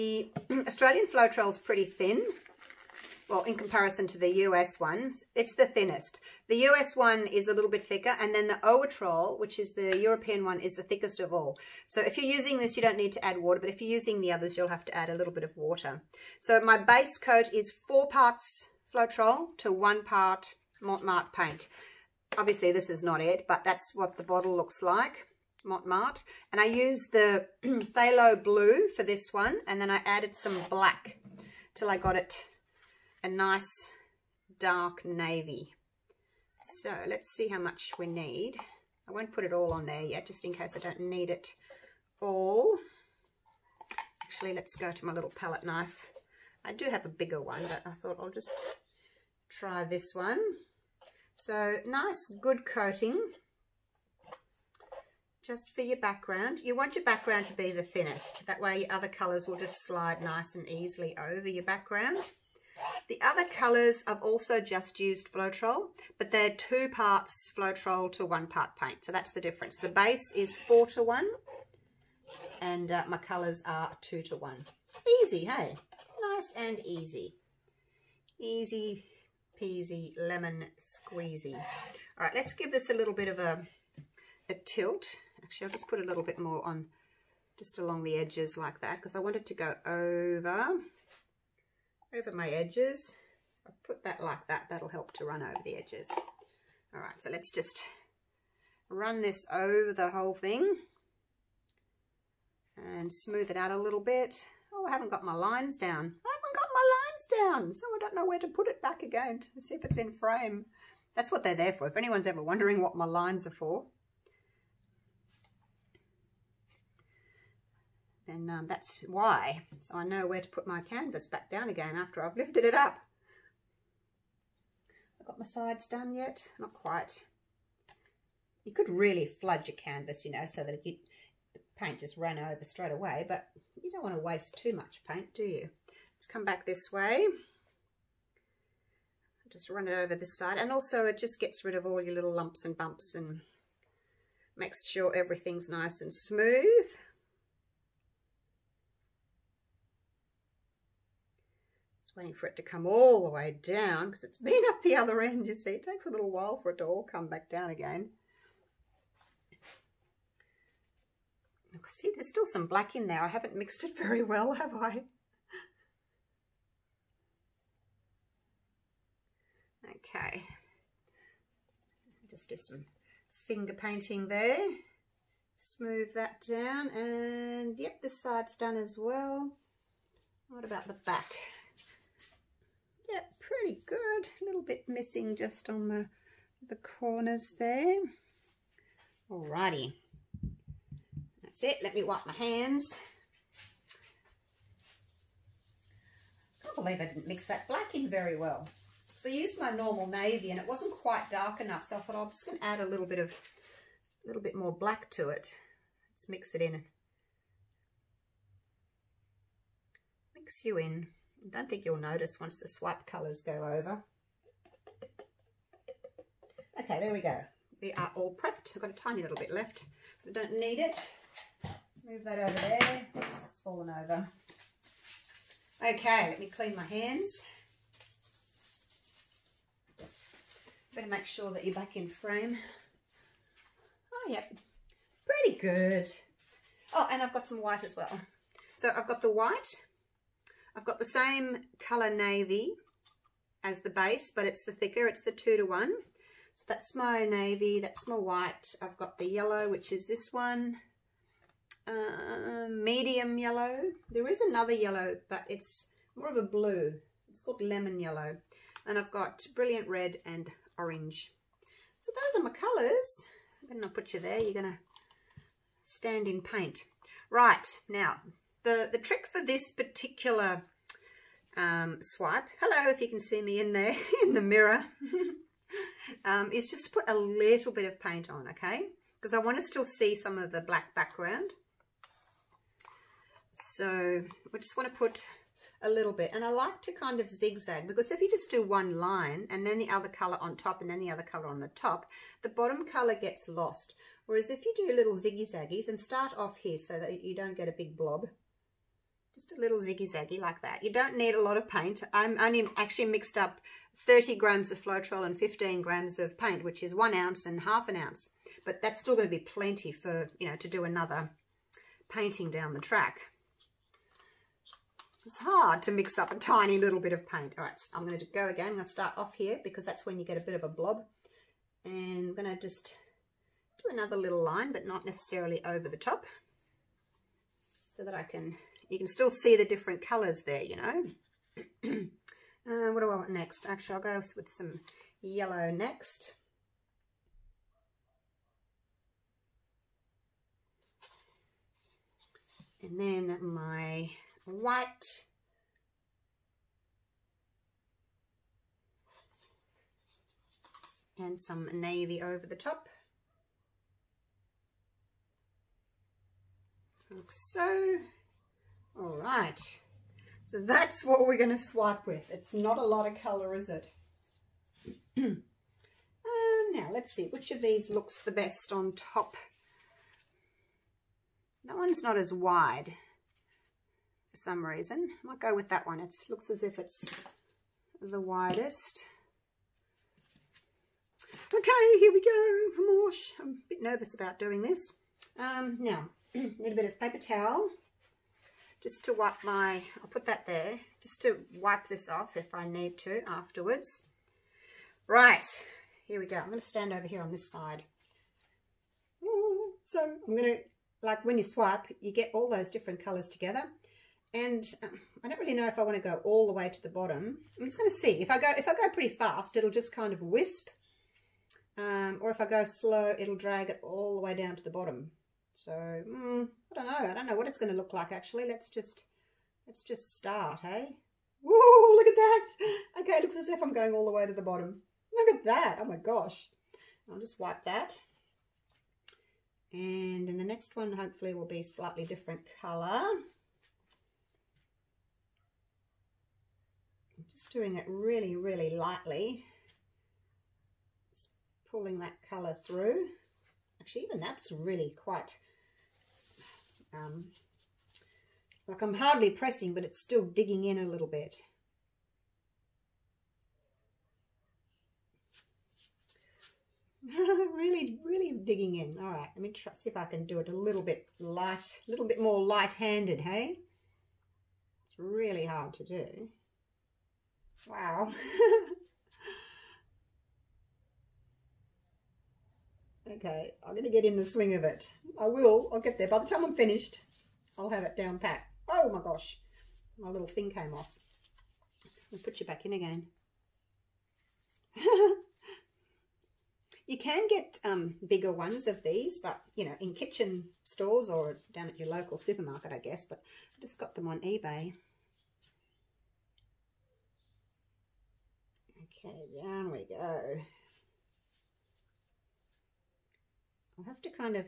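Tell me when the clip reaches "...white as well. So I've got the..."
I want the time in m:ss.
3:57.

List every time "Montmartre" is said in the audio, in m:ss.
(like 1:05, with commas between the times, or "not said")
0:20, 0:25.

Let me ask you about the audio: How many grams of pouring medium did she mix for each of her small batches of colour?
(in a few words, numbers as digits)
30 grams.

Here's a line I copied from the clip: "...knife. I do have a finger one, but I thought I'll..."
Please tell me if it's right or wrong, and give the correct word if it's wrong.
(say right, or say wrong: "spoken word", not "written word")
wrong: "bigger", not "finger".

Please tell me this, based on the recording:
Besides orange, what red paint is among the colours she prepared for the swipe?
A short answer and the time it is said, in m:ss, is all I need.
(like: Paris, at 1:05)
brilliant red, at 4:19.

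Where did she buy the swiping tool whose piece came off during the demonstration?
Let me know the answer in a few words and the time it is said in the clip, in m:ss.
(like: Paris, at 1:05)
eBay, at 8:14.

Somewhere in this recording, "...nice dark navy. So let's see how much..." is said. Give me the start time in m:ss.
0:33.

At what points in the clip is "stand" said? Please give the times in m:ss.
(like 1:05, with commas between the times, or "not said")
4:25, 6:36.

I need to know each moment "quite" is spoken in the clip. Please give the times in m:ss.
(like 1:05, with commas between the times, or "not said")
2:06, 3:20, 7:25.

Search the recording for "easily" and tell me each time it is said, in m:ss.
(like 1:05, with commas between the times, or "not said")
1:00.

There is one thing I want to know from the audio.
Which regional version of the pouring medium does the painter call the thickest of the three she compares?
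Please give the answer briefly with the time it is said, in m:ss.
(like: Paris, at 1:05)
Oatrol, at 0:08.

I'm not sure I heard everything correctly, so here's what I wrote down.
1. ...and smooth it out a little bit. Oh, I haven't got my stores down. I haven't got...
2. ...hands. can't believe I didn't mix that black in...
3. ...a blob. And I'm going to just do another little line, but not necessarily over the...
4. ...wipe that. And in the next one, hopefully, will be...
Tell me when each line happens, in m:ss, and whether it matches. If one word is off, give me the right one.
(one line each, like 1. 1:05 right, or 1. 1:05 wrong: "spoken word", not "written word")
1. 1:42 wrong: "lines", not "stores"
2. 3:12 right
3. 5:20 right
4. 7:07 right.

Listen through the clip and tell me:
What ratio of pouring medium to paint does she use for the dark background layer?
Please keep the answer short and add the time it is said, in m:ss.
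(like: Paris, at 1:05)
4 to 1, at 0:17.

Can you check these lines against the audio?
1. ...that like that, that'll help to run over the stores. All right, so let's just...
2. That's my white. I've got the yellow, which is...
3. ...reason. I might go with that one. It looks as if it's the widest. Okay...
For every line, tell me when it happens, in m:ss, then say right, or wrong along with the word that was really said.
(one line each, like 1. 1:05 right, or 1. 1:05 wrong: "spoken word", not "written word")
1. 1:34 wrong: "edges", not "stores"
2. 4:07 right
3. 6:14 right.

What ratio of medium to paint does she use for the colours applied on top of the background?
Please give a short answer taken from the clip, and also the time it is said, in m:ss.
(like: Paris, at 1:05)
2 to 1, at 1:06.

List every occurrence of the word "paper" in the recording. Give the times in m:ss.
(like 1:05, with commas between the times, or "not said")
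6:26.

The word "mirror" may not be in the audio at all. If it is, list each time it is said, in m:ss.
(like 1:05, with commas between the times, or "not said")
4:34.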